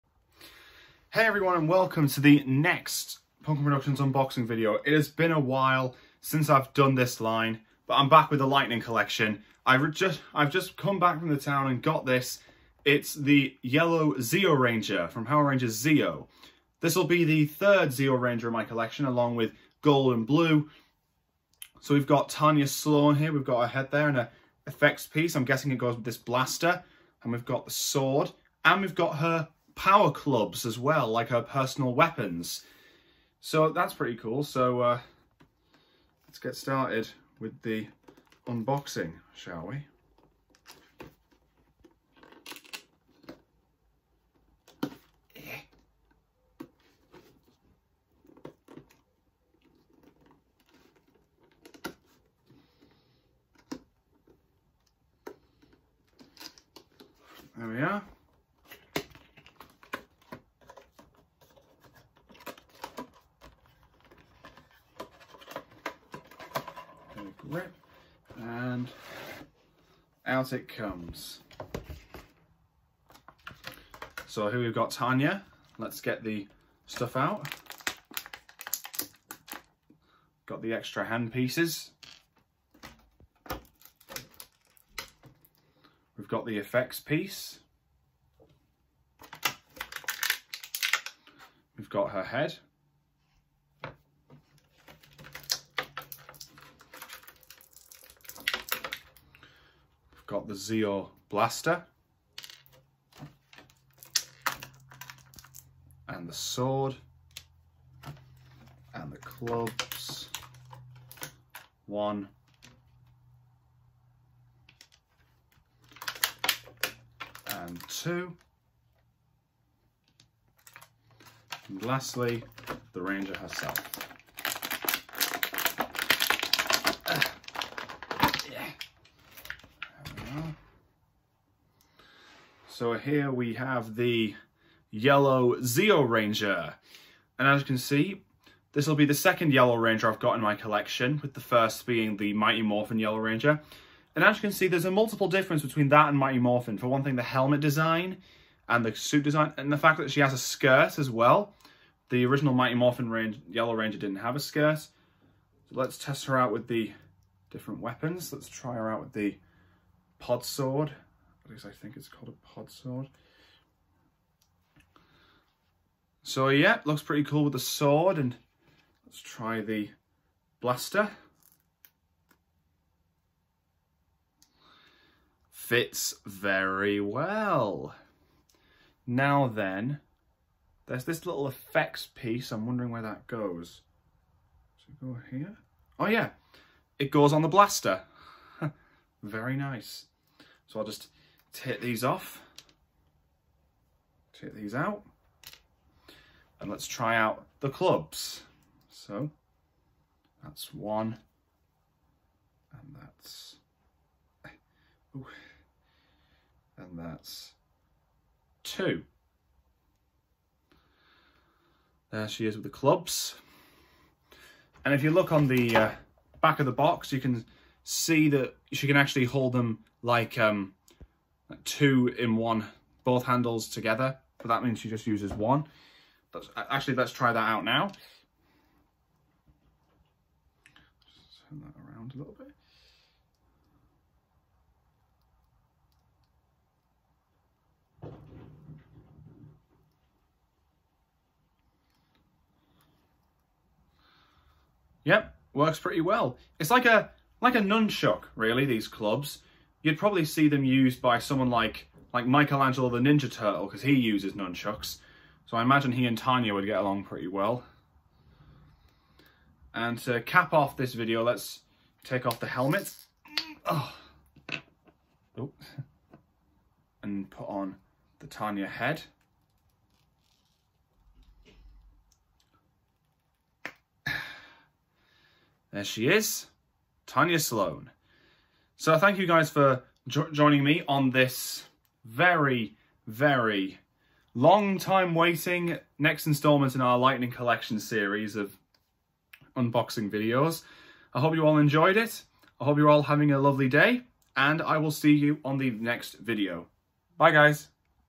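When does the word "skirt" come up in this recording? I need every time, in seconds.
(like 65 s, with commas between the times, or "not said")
150 s, 154 s.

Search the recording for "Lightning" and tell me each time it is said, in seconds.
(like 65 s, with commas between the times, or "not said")
8 s, 286 s.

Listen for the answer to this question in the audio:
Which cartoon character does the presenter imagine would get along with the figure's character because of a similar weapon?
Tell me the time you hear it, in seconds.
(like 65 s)
252 s.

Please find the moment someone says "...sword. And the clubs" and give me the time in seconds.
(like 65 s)
106 s.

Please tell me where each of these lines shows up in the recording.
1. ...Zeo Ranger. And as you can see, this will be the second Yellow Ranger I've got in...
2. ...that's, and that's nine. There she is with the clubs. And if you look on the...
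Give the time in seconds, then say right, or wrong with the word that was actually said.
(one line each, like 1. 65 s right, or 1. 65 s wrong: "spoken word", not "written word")
1. 135 s right
2. 202 s wrong: "two", not "nine".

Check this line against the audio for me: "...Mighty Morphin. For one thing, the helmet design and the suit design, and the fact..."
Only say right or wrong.
right.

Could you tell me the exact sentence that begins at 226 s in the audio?
That's, actually, let's try that out now.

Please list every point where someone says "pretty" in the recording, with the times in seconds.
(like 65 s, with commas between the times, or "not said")
33 s, 167 s, 245 s, 257 s.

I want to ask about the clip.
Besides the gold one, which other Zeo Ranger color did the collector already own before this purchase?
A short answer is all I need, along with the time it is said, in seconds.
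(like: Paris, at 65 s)
Blue, at 20 s.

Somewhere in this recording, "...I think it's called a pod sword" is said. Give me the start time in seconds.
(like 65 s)
161 s.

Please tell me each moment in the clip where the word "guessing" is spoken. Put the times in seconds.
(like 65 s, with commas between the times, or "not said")
25 s.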